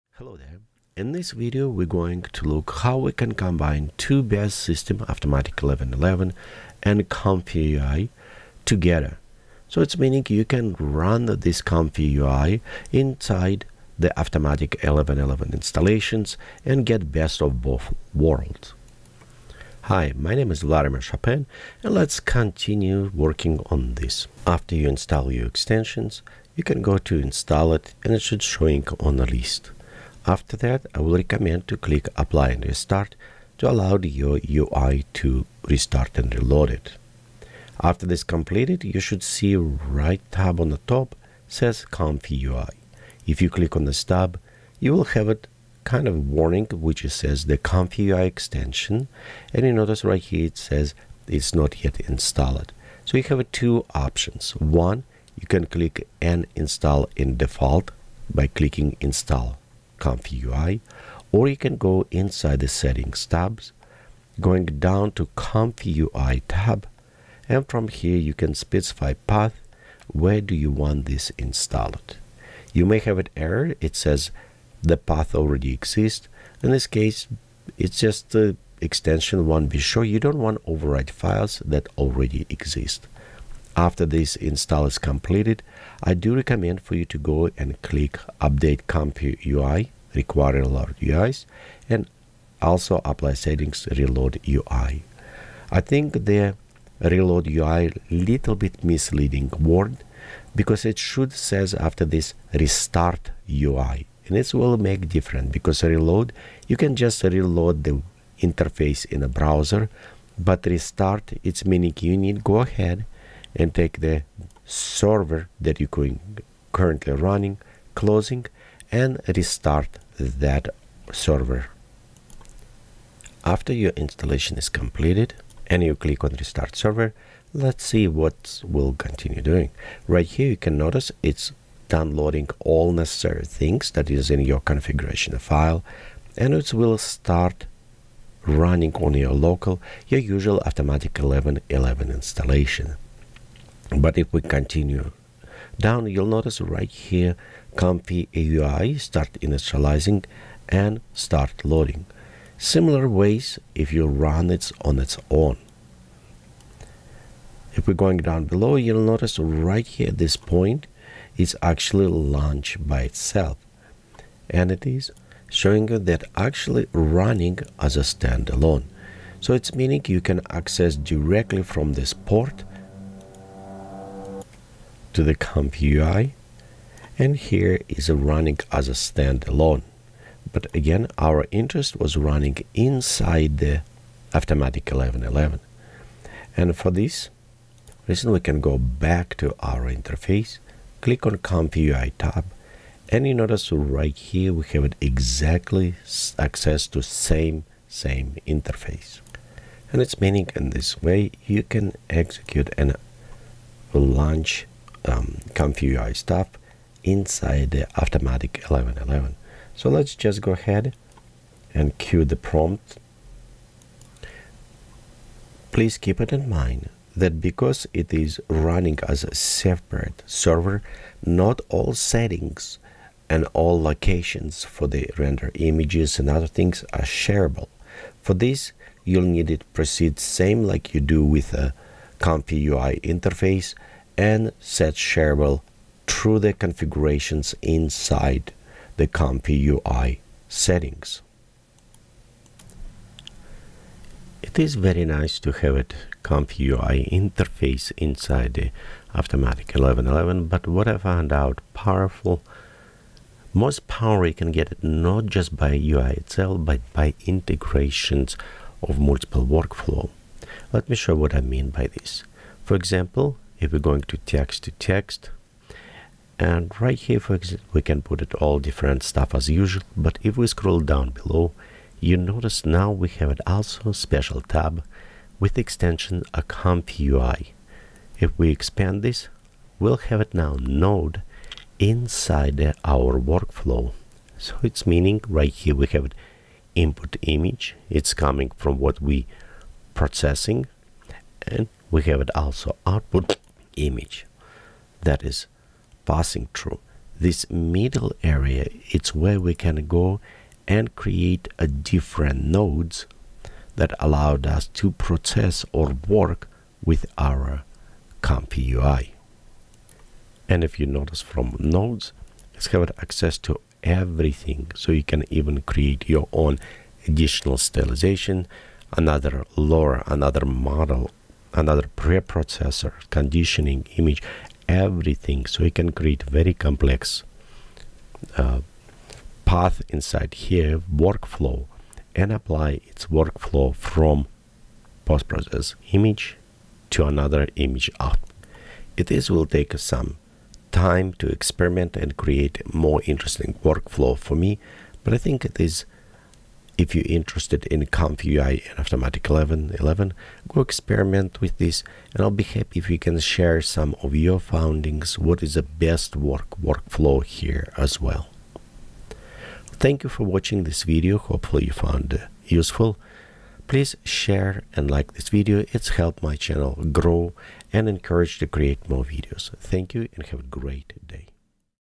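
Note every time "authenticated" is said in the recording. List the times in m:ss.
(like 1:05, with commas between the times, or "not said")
not said.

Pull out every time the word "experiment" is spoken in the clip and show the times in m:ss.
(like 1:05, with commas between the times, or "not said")
5:41, 5:50.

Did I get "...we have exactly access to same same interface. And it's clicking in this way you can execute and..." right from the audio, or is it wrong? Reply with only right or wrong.
wrong.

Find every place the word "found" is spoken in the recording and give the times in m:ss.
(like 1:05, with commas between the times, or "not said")
4:10, 6:01.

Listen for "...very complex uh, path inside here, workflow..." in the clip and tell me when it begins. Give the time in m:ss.
5:26.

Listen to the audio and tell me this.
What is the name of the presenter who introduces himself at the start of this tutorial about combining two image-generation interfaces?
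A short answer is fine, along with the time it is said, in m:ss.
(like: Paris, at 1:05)
Vladimir Chopine, at 0:20.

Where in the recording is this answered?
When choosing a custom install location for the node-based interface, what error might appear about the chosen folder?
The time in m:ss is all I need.
1:14.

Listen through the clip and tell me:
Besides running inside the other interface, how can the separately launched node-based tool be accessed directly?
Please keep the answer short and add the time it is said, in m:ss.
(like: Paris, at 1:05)
this port, at 2:51.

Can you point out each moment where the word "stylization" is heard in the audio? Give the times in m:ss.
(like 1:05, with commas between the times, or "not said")
5:17.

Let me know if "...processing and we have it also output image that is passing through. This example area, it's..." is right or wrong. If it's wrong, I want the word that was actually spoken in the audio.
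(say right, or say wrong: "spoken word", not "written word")
wrong: "middle", not "example".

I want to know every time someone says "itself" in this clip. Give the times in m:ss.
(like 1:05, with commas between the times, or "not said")
2:43, 4:16.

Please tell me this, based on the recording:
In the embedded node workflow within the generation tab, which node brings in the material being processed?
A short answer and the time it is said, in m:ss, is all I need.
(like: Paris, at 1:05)
input image, at 4:46.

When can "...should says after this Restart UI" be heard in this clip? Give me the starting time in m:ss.
1:40.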